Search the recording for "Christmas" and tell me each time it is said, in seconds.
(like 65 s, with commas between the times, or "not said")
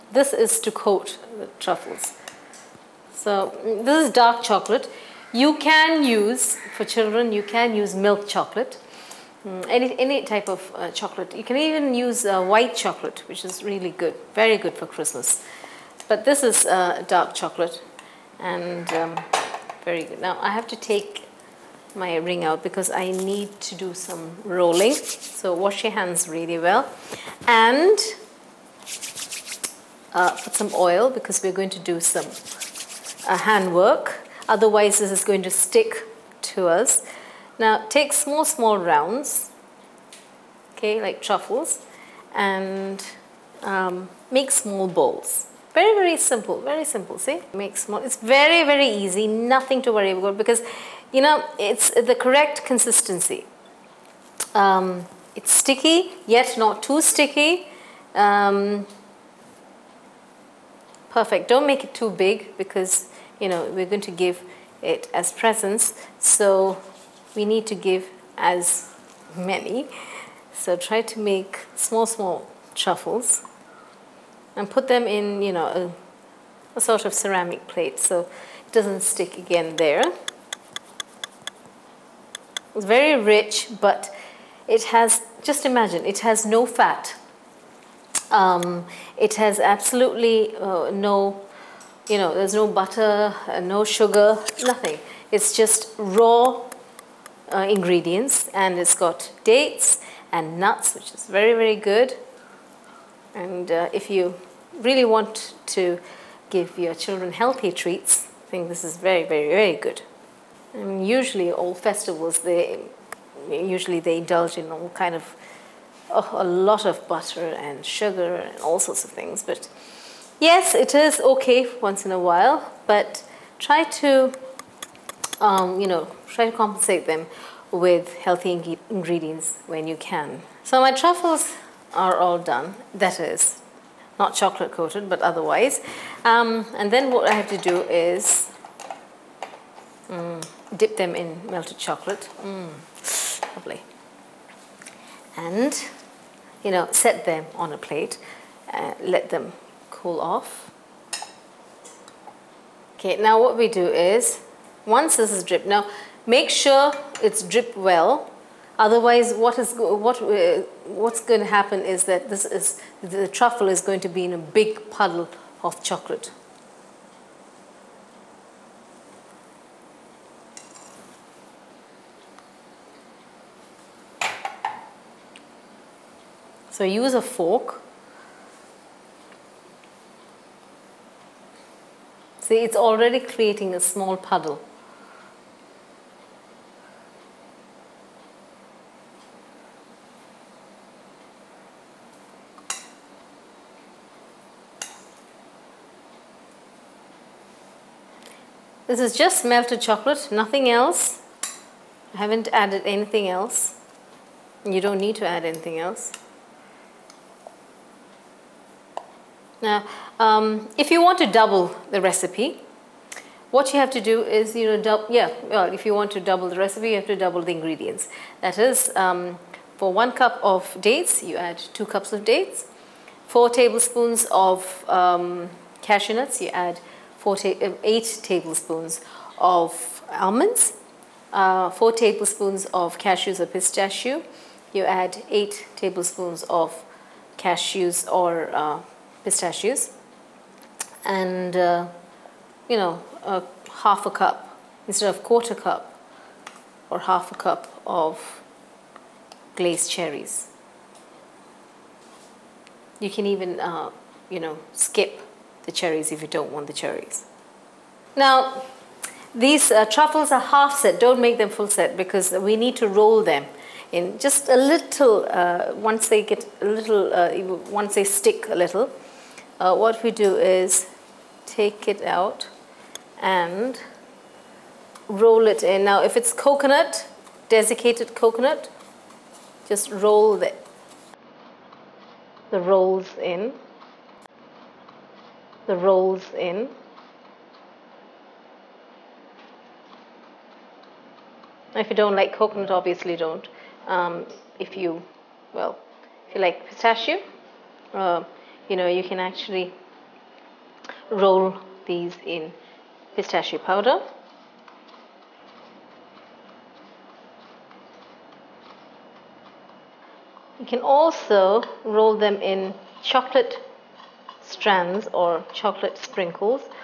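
14 s.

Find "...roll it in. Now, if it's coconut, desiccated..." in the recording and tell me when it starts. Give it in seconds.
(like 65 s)
275 s.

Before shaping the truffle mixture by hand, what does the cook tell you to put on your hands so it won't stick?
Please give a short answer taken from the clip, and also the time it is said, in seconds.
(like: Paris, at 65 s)
Oil, at 30 s.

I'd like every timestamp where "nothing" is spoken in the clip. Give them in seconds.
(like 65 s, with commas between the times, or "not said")
49 s, 94 s, 200 s.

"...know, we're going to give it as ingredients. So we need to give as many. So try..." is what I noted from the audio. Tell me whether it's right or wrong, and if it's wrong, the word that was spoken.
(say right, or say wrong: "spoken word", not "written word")
wrong: "presents", not "ingredients".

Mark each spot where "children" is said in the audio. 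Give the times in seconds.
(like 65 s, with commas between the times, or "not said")
6 s, 106 s.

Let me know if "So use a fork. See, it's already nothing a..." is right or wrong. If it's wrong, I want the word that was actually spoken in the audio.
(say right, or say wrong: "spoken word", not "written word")
wrong: "creating", not "nothing".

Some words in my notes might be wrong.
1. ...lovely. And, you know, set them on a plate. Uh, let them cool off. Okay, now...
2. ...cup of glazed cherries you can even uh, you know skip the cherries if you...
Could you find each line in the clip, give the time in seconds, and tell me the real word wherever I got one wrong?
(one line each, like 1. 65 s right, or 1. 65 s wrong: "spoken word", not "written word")
1. 143 s right
2. 247 s right.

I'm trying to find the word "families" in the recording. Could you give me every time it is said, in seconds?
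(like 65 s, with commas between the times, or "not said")
not said.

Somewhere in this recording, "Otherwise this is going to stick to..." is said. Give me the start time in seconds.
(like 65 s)
34 s.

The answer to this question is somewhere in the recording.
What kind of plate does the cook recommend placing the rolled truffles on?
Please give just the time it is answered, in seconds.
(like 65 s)
77 s.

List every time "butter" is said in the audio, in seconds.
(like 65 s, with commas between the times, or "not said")
92 s, 117 s.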